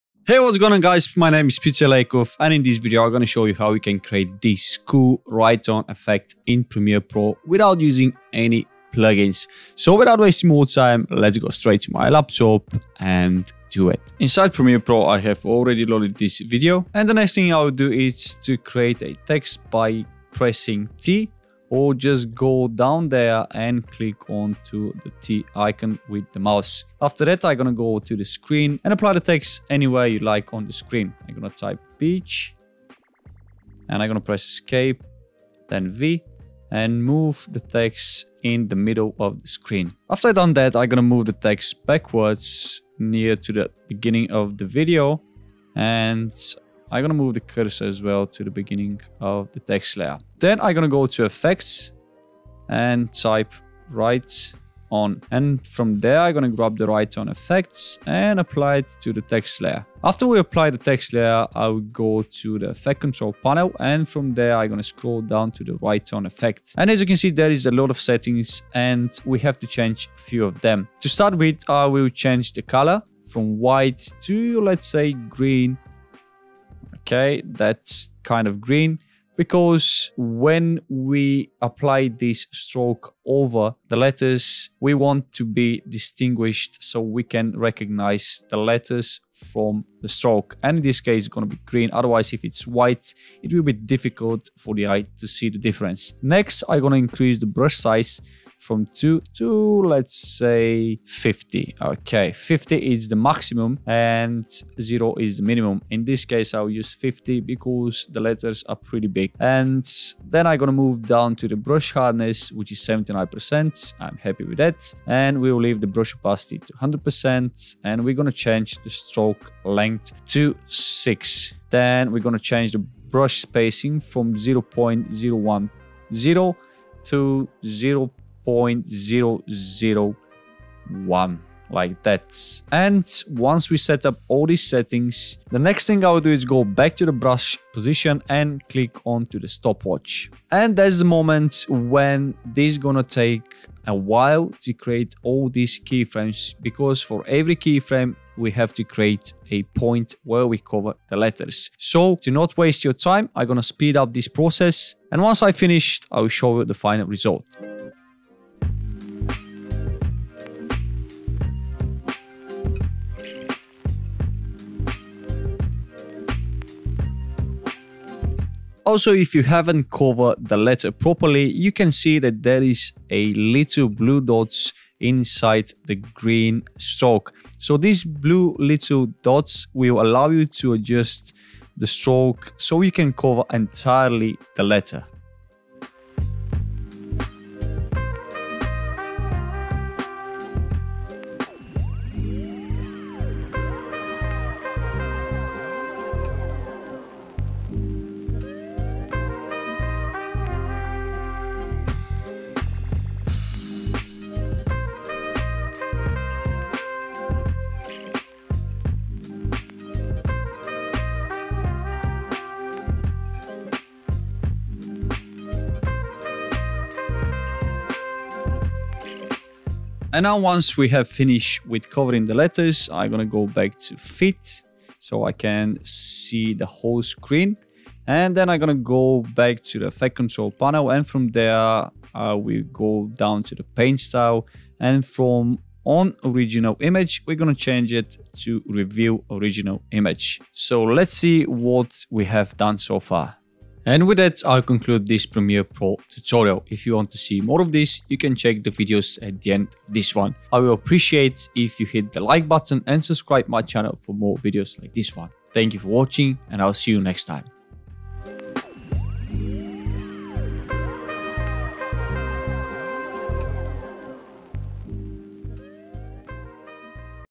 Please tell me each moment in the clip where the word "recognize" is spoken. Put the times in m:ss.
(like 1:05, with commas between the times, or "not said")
1:27.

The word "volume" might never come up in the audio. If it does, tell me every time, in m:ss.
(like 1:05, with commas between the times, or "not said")
not said.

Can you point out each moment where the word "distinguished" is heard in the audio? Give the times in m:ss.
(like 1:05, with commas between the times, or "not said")
1:25.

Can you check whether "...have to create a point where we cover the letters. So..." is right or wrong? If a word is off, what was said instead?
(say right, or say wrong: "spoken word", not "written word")
right.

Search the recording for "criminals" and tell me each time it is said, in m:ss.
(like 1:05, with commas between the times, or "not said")
not said.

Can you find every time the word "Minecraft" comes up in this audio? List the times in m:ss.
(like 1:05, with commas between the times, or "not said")
not said.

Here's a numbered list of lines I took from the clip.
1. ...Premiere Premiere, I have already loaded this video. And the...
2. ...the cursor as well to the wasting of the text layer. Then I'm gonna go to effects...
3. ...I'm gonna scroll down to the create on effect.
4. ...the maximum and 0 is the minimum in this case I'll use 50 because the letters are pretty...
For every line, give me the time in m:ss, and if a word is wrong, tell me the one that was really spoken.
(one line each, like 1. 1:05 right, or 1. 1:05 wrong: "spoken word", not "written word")
1. 0:14 wrong: "Pro", not "Premiere"
2. 0:47 wrong: "beginning", not "wasting"
3. 1:04 wrong: "write", not "create"
4. 1:43 right.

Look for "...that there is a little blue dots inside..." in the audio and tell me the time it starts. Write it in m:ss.
2:52.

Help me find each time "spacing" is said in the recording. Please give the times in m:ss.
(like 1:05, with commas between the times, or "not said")
2:03.